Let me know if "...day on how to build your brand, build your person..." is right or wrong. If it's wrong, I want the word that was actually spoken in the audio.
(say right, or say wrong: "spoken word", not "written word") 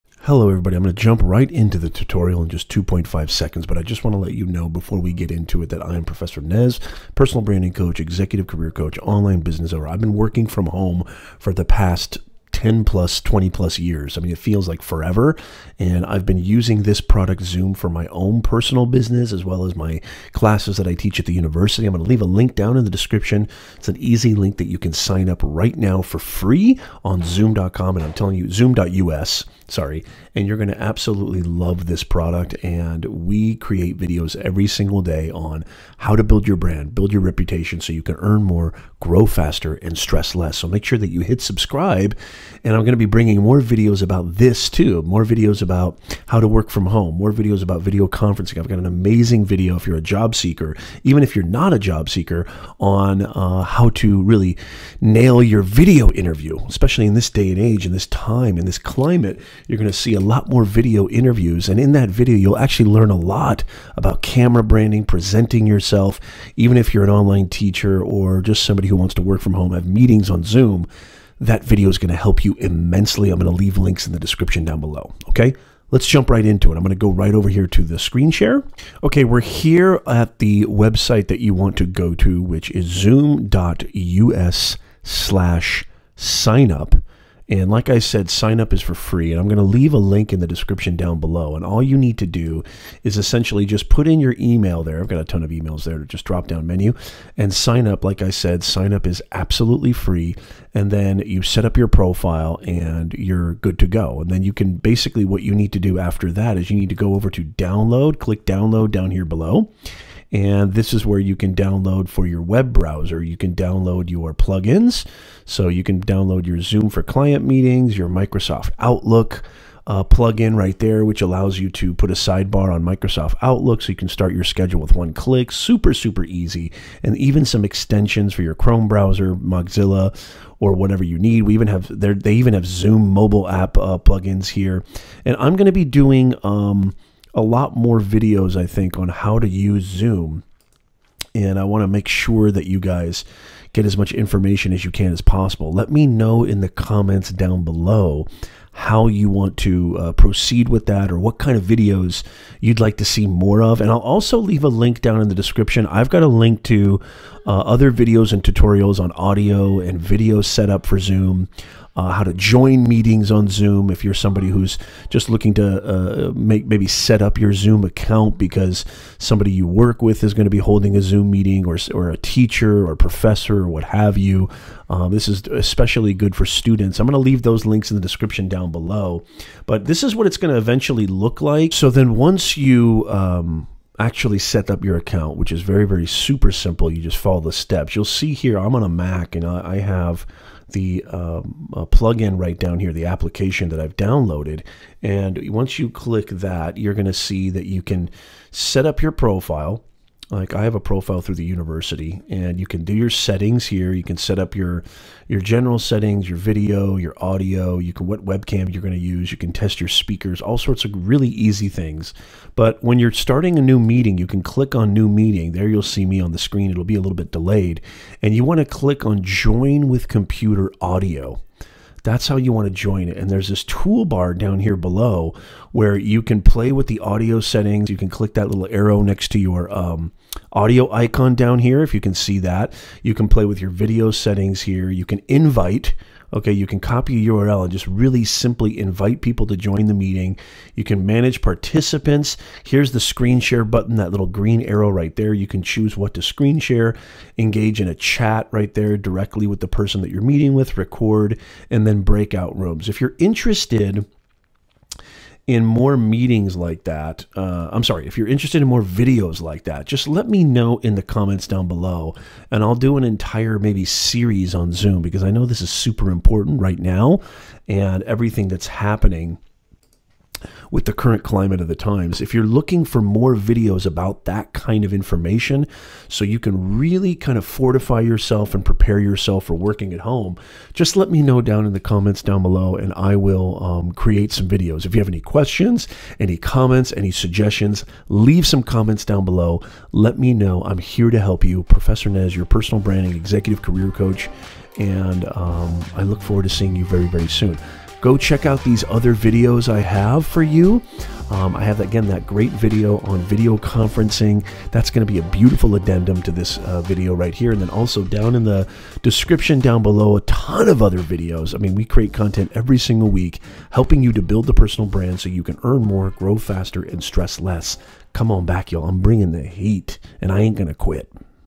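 wrong: "reputation", not "person".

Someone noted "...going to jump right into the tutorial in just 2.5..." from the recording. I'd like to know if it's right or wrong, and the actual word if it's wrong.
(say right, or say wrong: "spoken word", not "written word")
right.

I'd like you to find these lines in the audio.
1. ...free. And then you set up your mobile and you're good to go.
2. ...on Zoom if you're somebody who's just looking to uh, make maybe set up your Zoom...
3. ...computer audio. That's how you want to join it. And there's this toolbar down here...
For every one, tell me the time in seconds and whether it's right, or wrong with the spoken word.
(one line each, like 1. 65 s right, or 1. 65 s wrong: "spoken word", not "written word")
1. 99 s wrong: "profile", not "mobile"
2. 163 s right
3. 220 s right.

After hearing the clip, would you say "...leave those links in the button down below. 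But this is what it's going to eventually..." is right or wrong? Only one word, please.
wrong.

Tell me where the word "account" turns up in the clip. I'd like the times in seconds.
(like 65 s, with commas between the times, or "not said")
167 s, 184 s.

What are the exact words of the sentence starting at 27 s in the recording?
And I'm telling you, zoom.us sorry.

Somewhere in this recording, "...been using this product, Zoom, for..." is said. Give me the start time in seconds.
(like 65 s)
16 s.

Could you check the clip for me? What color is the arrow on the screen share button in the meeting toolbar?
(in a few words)
Green.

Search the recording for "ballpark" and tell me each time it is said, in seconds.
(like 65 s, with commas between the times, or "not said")
not said.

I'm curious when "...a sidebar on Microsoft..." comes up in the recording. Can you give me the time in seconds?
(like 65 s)
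122 s.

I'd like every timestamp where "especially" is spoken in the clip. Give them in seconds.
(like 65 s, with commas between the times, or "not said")
56 s, 175 s.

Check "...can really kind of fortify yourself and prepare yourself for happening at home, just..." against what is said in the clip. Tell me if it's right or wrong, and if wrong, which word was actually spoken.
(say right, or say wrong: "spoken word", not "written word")
wrong: "working", not "happening".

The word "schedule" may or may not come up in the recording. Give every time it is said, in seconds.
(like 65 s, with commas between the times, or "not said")
124 s.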